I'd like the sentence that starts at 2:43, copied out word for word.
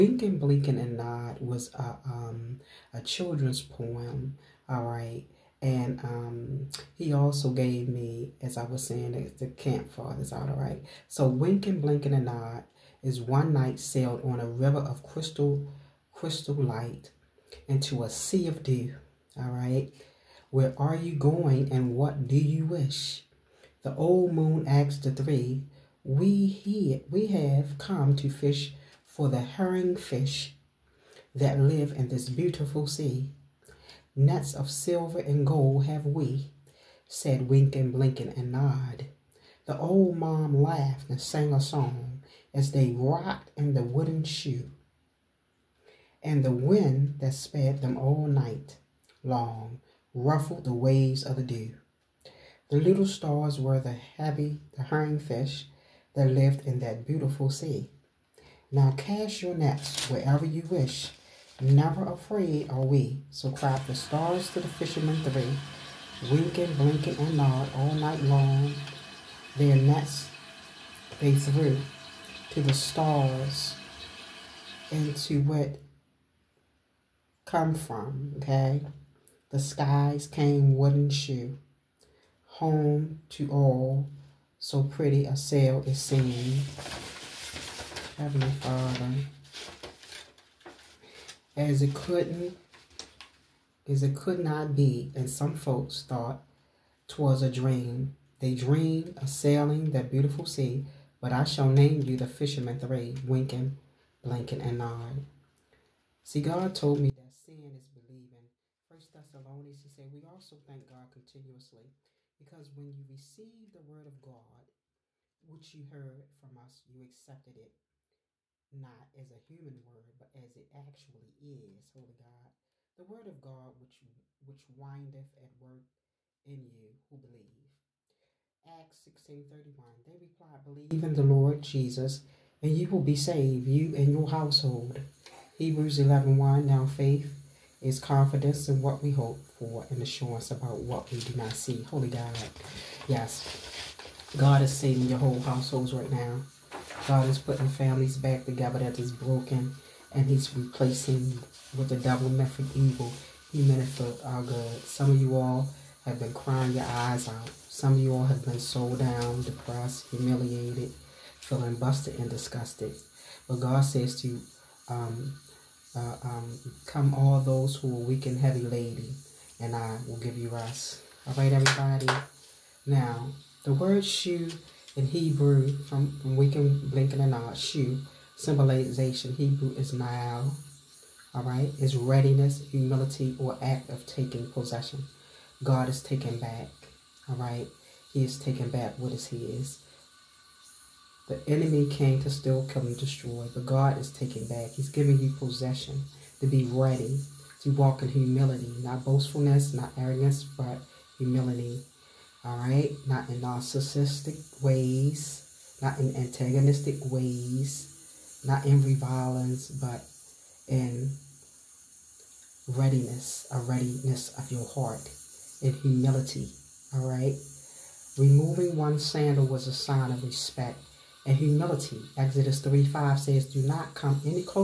But God says to um, uh, um, come all those who are weak and heavy laden, and I will give you rest.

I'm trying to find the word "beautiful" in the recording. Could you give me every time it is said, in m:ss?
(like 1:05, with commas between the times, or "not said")
0:32, 0:57, 1:40.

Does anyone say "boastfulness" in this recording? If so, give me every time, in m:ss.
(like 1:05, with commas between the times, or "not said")
3:19.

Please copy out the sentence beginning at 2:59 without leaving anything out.
Hebrew is now, all right, is readiness, humility, or act of taking possession.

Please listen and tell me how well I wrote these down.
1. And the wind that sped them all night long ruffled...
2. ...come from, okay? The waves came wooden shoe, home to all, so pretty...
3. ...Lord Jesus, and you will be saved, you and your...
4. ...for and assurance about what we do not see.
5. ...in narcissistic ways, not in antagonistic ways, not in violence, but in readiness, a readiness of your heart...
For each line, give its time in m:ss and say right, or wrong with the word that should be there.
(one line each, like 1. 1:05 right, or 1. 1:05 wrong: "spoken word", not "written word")
1. 0:46 right
2. 1:17 wrong: "skies", not "waves"
3. 2:11 right
4. 2:19 right
5. 3:23 right.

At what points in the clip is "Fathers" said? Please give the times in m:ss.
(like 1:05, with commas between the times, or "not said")
0:09, 1:28.